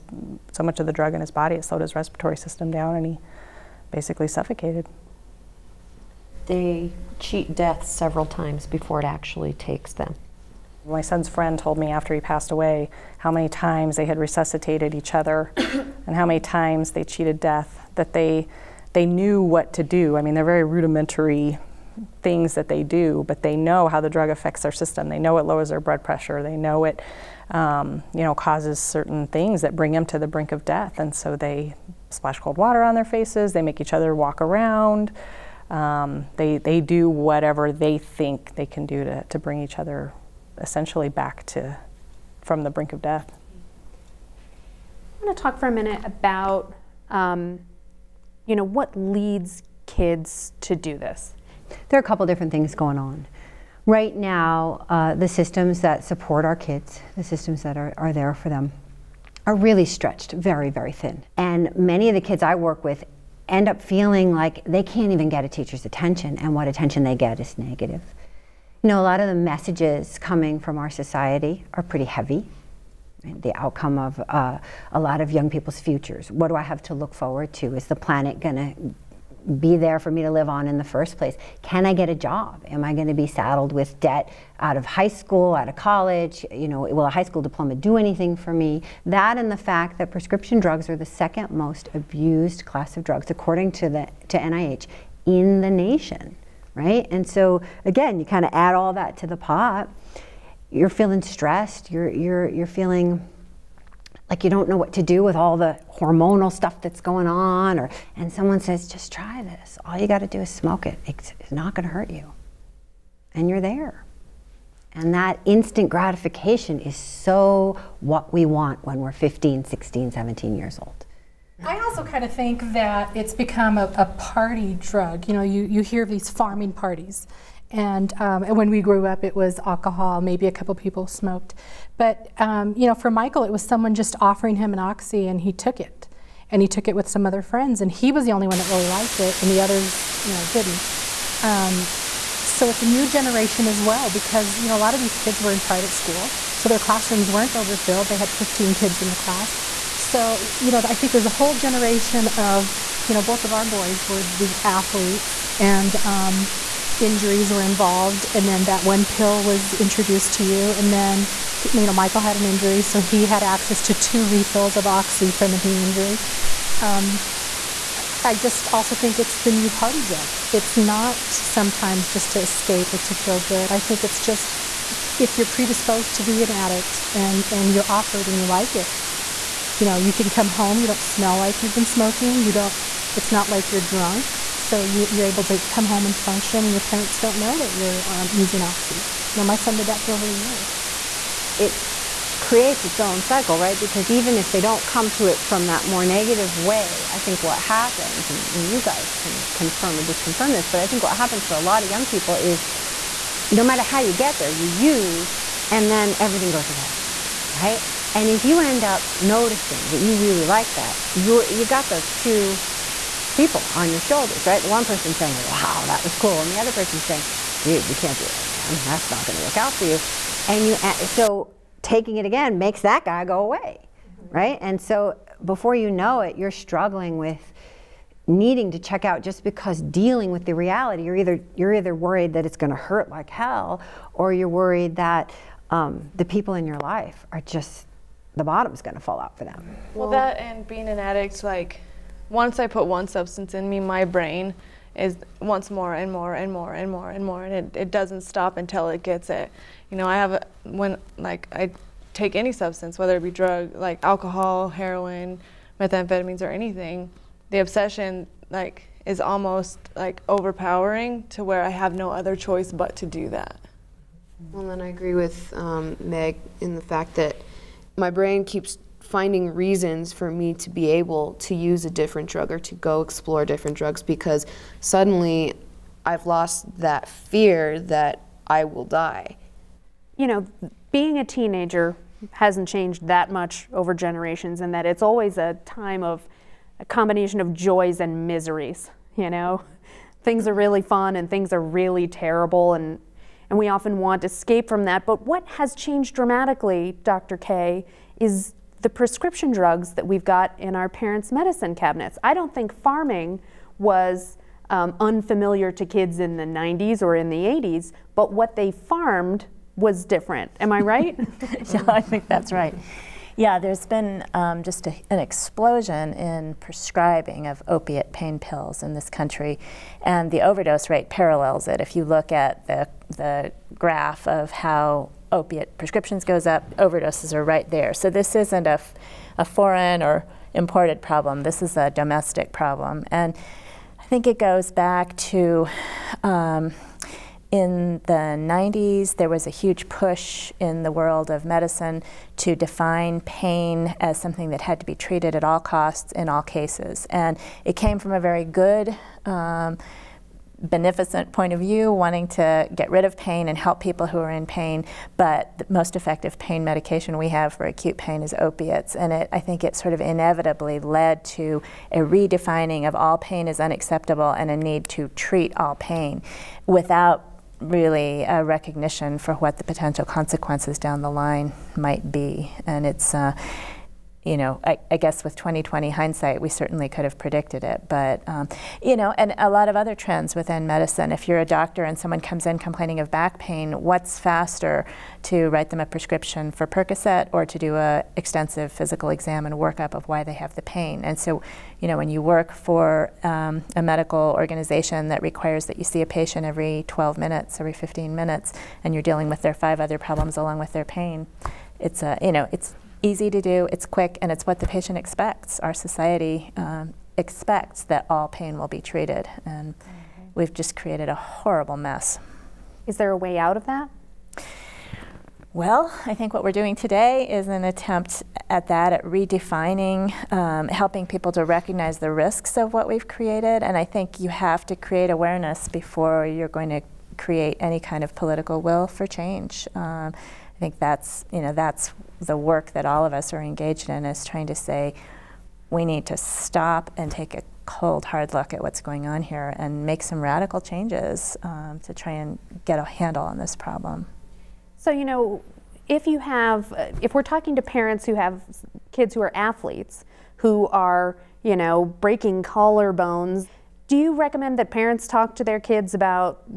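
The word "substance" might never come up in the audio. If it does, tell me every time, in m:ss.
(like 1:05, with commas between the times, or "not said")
4:03, 4:12.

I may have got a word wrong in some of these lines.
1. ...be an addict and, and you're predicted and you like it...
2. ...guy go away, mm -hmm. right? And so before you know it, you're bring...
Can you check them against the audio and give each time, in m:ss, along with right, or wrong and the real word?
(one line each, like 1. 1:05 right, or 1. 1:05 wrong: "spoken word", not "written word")
1. 2:56 wrong: "offered", not "predicted"
2. 3:43 wrong: "struggling", not "bring".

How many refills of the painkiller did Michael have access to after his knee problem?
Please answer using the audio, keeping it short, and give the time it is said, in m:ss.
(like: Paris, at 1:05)
2, at 2:43.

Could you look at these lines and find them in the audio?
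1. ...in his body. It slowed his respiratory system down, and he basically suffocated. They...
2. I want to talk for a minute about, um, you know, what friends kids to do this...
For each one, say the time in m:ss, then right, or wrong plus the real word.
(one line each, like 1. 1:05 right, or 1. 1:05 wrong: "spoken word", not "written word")
1. 0:01 right
2. 0:45 wrong: "leads", not "friends".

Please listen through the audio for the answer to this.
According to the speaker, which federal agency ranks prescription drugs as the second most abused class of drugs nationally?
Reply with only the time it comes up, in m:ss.
1:34.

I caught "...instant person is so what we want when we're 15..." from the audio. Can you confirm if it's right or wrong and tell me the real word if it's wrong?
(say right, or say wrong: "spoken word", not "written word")
wrong: "gratification", not "person".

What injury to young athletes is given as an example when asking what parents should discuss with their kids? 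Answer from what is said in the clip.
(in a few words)
Breaking collarbones.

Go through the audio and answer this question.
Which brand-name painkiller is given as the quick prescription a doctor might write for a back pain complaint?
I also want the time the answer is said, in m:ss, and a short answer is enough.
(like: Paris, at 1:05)
Percocet, at 6:26.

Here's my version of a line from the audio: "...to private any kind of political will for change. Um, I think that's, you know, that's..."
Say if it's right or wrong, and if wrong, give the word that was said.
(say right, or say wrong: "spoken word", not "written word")
wrong: "create", not "private".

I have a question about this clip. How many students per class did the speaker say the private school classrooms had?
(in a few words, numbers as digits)
15.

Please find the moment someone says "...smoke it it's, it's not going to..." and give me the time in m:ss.
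1:50.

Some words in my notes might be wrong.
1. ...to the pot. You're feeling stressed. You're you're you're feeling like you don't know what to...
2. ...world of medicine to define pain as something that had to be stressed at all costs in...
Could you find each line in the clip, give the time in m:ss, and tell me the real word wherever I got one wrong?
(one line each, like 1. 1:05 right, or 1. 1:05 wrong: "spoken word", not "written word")
1. 1:39 right
2. 5:40 wrong: "treated", not "stressed".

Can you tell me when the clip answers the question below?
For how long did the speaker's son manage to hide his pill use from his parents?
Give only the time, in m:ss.
3:10.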